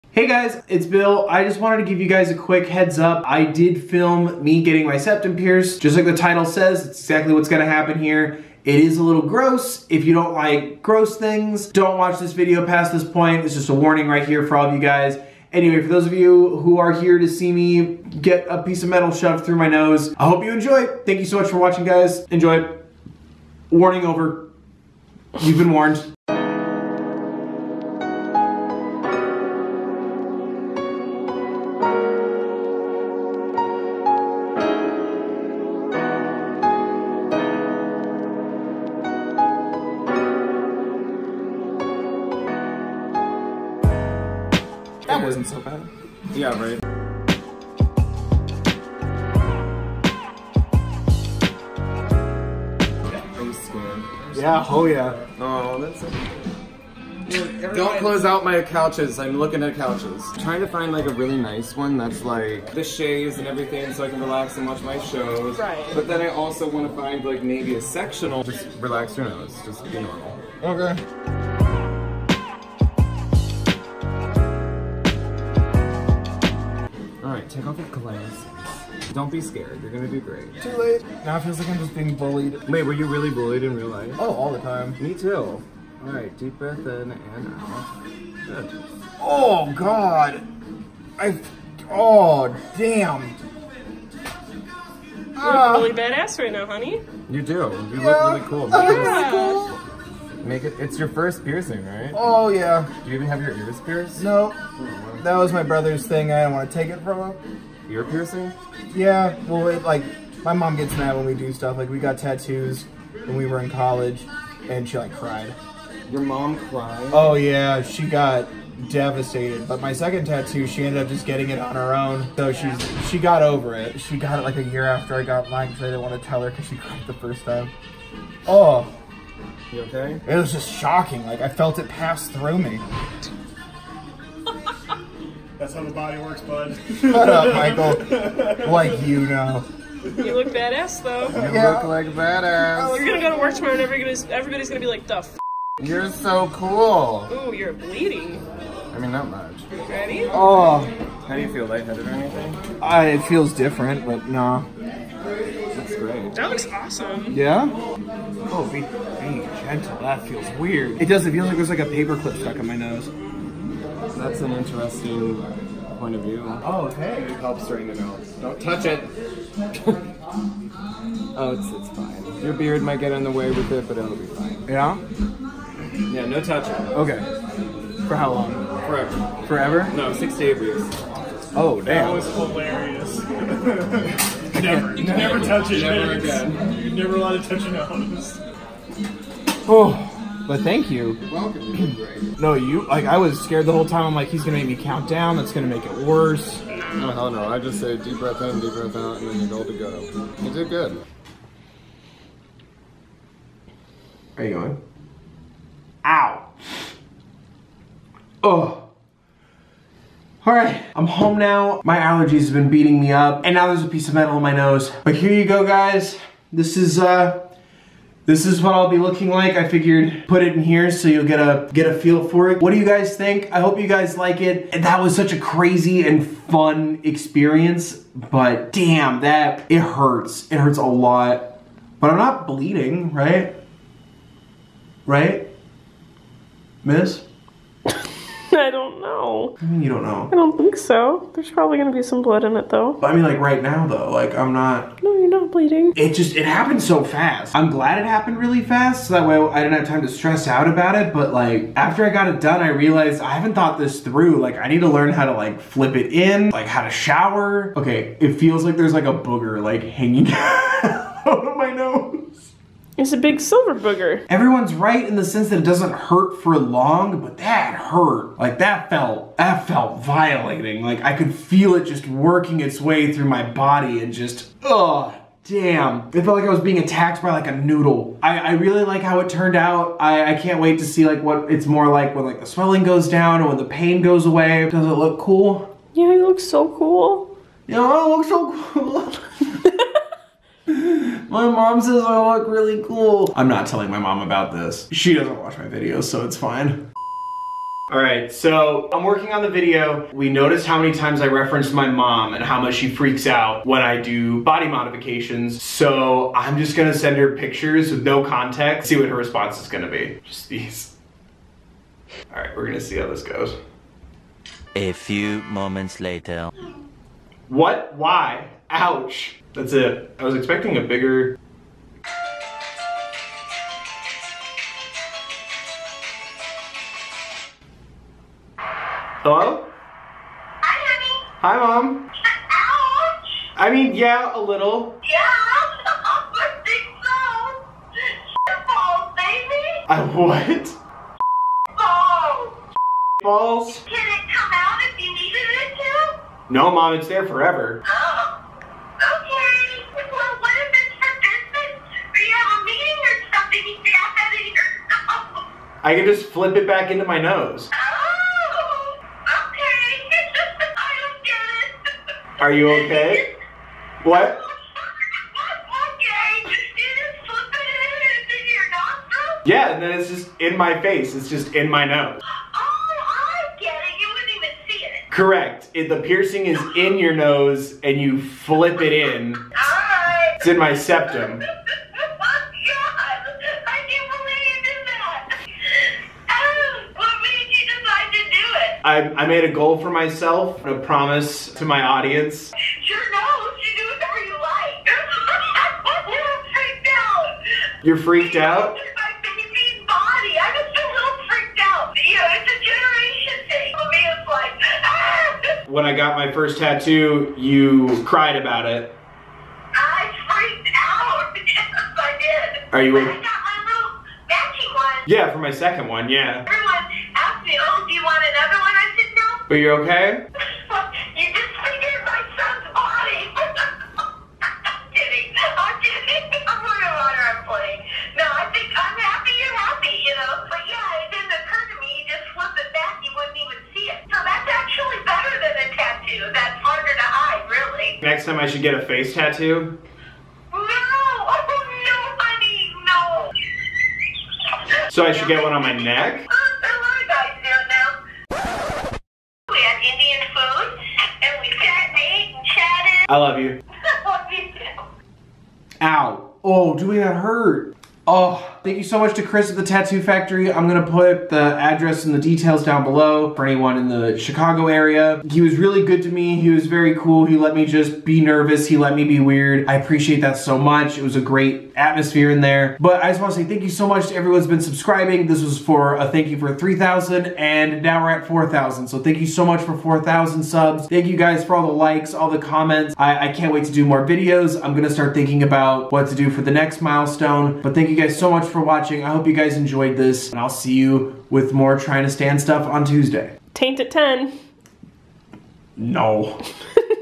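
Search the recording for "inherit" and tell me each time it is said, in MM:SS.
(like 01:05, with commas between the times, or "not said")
not said.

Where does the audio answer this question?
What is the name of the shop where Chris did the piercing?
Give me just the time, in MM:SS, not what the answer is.
07:39.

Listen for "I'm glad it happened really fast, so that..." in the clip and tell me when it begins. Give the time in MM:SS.
04:07.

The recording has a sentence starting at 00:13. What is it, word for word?
It's just a warning right here for all of you guys.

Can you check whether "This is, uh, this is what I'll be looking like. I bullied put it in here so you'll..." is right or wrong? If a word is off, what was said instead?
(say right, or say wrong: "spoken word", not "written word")
wrong: "figured", not "bullied".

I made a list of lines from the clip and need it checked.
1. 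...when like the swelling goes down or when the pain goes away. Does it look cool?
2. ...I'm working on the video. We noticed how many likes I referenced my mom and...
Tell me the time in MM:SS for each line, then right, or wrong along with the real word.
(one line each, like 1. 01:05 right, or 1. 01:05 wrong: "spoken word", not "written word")
1. 04:42 right
2. 04:58 wrong: "times", not "likes".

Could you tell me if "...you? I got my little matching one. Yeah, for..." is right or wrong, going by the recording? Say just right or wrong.
right.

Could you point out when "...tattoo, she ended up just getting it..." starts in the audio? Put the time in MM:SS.
02:00.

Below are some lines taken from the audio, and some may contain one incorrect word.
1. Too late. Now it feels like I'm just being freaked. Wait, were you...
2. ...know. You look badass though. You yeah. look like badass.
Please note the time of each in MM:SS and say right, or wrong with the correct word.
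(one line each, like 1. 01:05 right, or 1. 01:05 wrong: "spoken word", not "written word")
1. 01:20 wrong: "bullied", not "freaked"
2. 02:19 right.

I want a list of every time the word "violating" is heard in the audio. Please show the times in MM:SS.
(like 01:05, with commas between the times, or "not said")
04:30.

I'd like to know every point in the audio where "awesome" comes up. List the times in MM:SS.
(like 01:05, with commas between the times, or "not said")
02:36.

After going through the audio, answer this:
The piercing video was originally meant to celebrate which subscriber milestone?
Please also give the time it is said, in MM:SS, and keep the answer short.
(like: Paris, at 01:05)
3,000, at 07:56.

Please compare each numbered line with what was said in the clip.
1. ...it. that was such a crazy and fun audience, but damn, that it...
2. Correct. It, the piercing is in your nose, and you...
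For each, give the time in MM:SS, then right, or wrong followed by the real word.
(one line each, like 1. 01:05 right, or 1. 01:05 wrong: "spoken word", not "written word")
1. 03:44 wrong: "experience", not "audience"
2. 06:15 right.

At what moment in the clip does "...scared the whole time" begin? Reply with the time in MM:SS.
03:13.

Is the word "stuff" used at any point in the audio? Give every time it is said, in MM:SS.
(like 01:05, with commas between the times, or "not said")
01:51, 08:12.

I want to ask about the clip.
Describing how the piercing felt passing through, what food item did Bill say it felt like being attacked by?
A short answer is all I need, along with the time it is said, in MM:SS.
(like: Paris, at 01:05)
noodle, at 04:37.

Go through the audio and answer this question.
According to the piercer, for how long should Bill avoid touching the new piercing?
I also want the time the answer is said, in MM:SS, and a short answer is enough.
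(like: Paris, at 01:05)
six to eight weeks, at 03:00.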